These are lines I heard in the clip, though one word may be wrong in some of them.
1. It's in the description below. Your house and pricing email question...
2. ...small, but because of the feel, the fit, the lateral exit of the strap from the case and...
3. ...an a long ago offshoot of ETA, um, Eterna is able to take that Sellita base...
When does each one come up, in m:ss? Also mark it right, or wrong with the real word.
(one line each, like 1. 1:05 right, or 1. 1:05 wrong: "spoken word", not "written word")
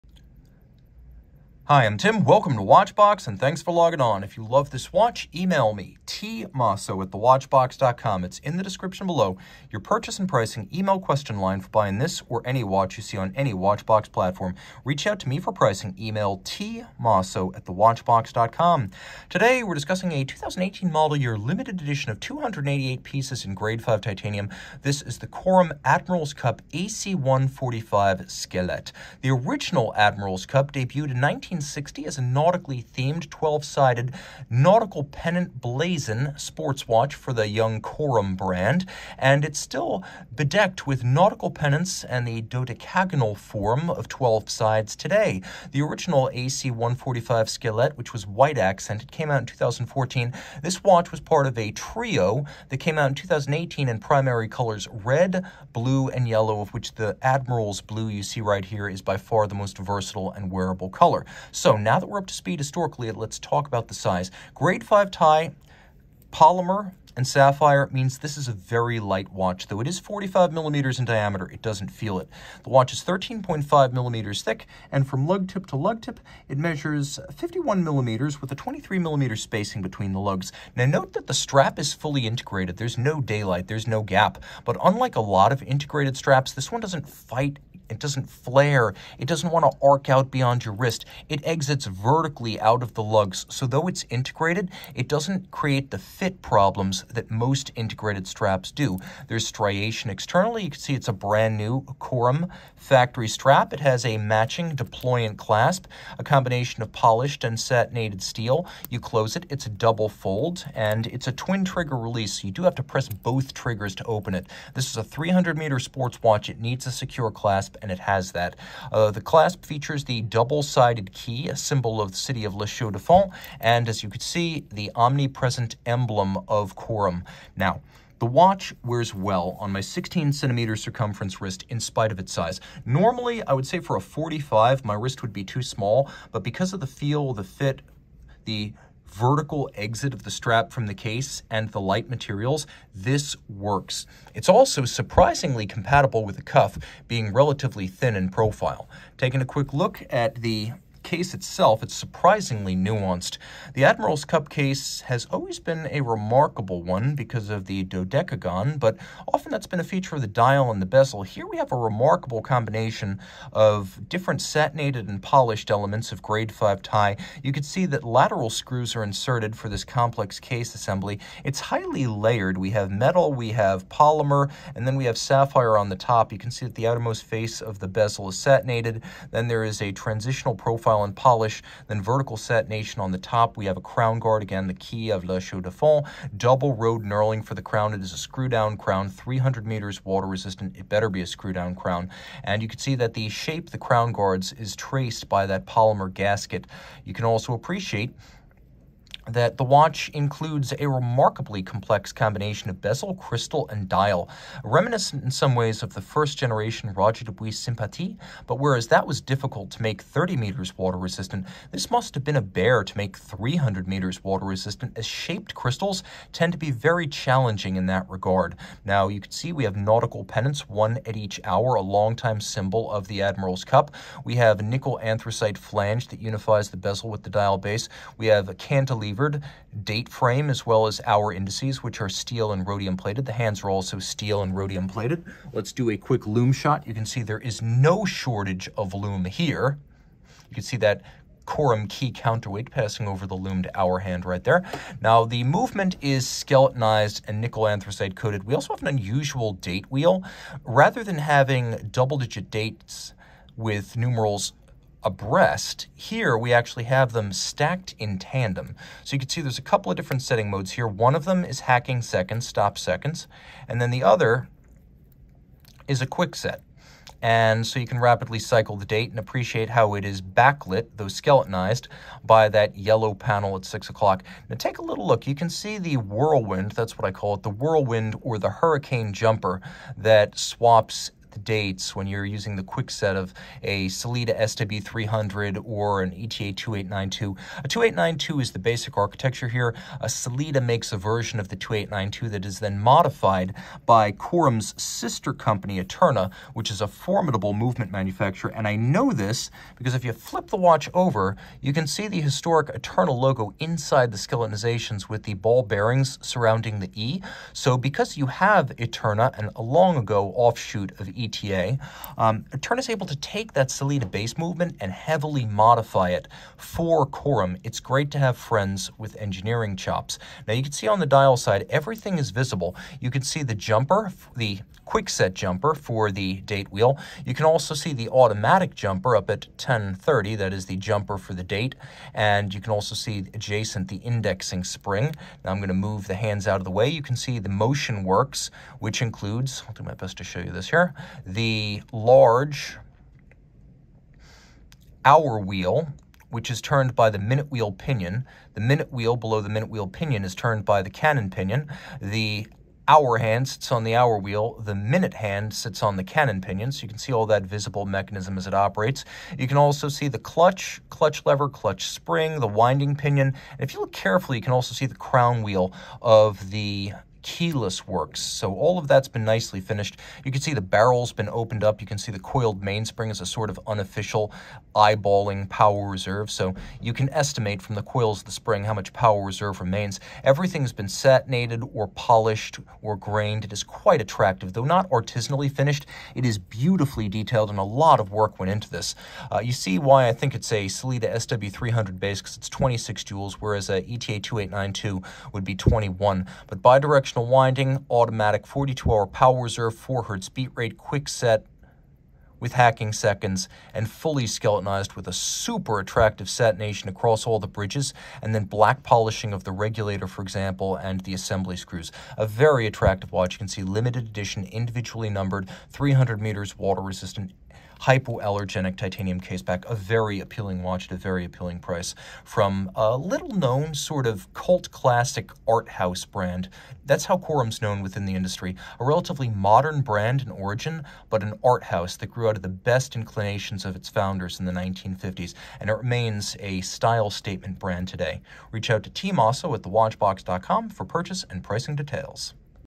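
1. 0:08 wrong: "purchase", not "house"
2. 2:15 wrong: "vertical", not "lateral"
3. 5:09 right.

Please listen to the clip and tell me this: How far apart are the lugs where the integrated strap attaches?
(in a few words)
23 millimeters.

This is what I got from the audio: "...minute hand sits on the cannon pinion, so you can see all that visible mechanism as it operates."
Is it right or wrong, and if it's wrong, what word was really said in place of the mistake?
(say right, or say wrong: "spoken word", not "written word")
right.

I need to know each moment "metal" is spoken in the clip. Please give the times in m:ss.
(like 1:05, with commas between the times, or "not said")
2:52.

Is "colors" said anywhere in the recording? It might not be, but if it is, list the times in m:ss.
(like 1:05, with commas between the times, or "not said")
0:54, 1:00.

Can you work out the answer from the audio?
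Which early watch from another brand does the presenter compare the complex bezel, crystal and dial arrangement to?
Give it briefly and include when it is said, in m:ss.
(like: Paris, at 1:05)
Roger Dubuis Sympathie, at 3:26.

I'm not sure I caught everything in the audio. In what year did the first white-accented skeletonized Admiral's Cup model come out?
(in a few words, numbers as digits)
2014.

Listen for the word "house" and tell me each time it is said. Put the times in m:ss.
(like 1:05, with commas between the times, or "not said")
7:05, 7:11.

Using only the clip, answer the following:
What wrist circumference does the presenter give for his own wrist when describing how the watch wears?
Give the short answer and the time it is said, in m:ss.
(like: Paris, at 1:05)
16 centimeters, at 2:09.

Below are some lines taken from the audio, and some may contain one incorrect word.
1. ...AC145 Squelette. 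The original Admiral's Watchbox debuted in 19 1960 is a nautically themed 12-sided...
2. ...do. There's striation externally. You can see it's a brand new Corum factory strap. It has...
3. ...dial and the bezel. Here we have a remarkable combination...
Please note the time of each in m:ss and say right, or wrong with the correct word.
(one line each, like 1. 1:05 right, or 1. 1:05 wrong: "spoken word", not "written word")
1. 0:26 wrong: "Cup", not "Watchbox"
2. 1:38 right
3. 2:40 right.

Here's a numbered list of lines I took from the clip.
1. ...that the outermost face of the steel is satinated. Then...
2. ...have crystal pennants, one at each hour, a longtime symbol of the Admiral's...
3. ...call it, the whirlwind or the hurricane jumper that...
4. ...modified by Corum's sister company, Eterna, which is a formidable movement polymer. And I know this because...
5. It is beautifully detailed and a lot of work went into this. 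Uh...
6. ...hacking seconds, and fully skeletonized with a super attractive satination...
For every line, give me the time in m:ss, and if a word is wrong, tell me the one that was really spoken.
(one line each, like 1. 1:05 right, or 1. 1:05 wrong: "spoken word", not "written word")
1. 2:56 wrong: "bezel", not "steel"
2. 3:39 wrong: "nautical", not "crystal"
3. 4:37 right
4. 4:52 wrong: "manufacturer", not "polymer"
5. 6:26 right
6. 6:42 right.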